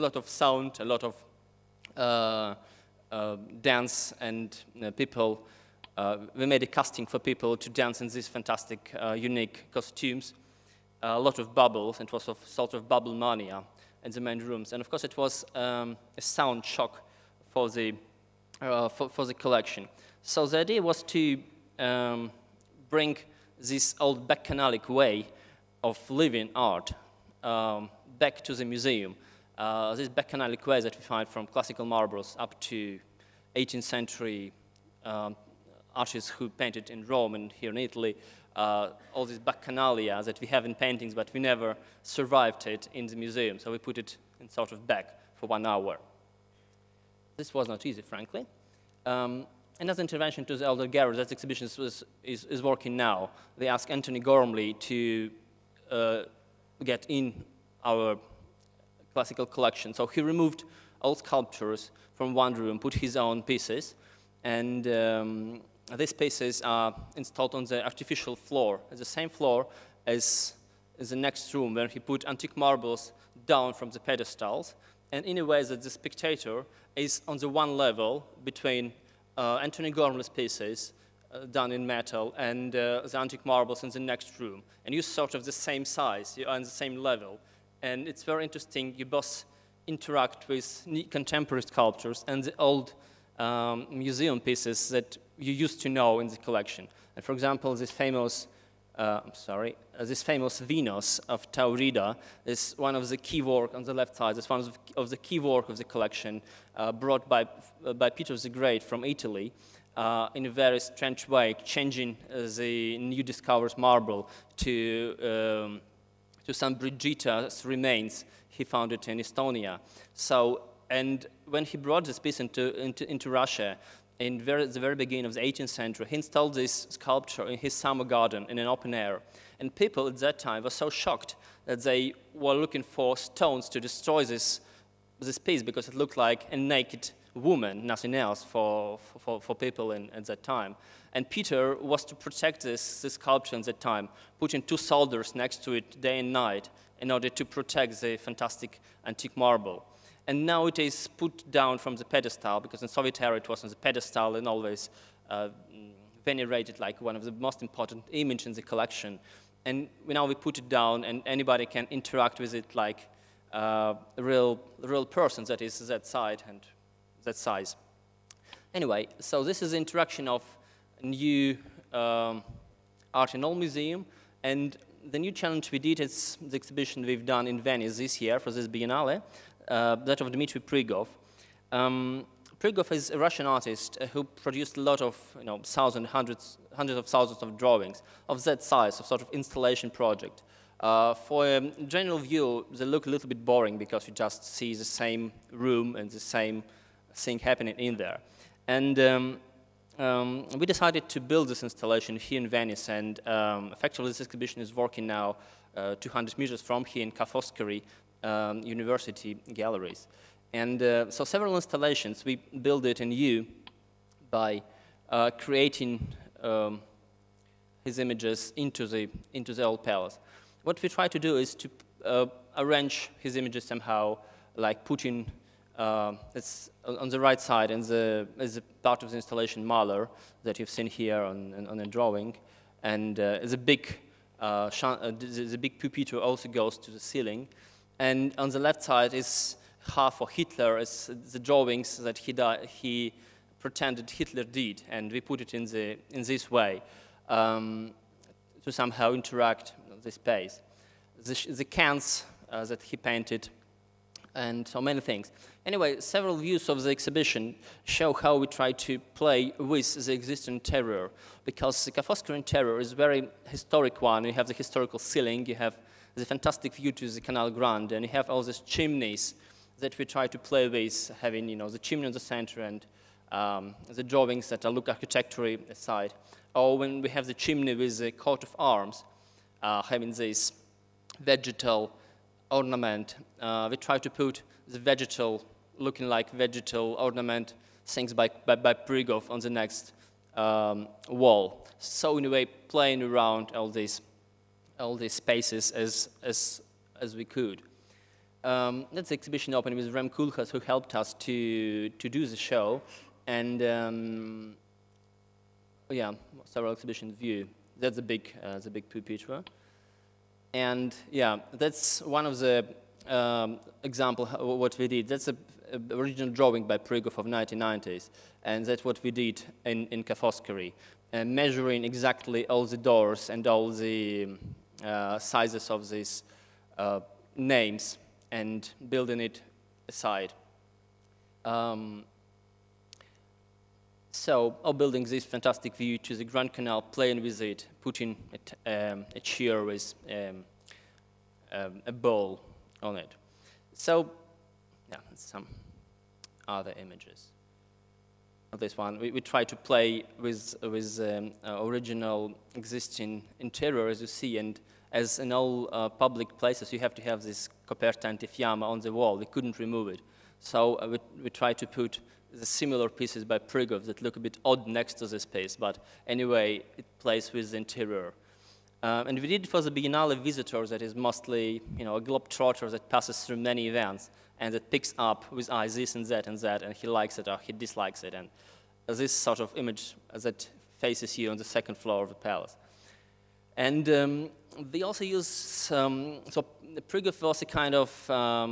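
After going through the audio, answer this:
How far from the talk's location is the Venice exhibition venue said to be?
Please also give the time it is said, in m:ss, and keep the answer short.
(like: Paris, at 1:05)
200 meters, at 3:26.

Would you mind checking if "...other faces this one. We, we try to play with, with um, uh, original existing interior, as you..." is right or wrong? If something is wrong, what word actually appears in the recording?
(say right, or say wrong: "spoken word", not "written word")
wrong: "images", not "faces".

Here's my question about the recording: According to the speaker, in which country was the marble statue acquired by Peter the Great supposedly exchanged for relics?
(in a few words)
Estonia.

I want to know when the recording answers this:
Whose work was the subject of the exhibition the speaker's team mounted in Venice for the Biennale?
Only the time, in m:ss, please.
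3:00.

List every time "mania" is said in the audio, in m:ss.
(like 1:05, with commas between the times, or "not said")
0:13.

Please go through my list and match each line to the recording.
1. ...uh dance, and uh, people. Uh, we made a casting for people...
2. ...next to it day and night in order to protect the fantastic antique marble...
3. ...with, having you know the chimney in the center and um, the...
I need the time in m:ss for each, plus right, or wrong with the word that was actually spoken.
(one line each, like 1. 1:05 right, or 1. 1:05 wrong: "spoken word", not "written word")
1. 0:03 right
2. 2:25 right
3. 4:30 right.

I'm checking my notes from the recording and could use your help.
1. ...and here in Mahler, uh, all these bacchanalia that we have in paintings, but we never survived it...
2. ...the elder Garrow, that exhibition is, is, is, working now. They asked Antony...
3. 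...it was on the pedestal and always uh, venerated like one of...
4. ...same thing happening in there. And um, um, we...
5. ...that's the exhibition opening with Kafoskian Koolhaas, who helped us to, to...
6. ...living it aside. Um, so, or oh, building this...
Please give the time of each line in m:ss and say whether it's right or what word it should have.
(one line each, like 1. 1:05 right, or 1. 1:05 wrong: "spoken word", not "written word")
1. 0:37 wrong: "Italy", not "Mahler"
2. 0:50 right
3. 2:33 right
4. 3:16 right
5. 4:58 wrong: "Rem", not "Kafoskian"
6. 5:28 wrong: "building", not "living".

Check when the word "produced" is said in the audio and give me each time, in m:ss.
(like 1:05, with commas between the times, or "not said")
3:04.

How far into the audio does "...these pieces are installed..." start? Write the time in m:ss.
1:05.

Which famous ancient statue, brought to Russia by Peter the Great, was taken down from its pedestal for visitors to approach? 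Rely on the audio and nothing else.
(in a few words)
Venus of Taurida.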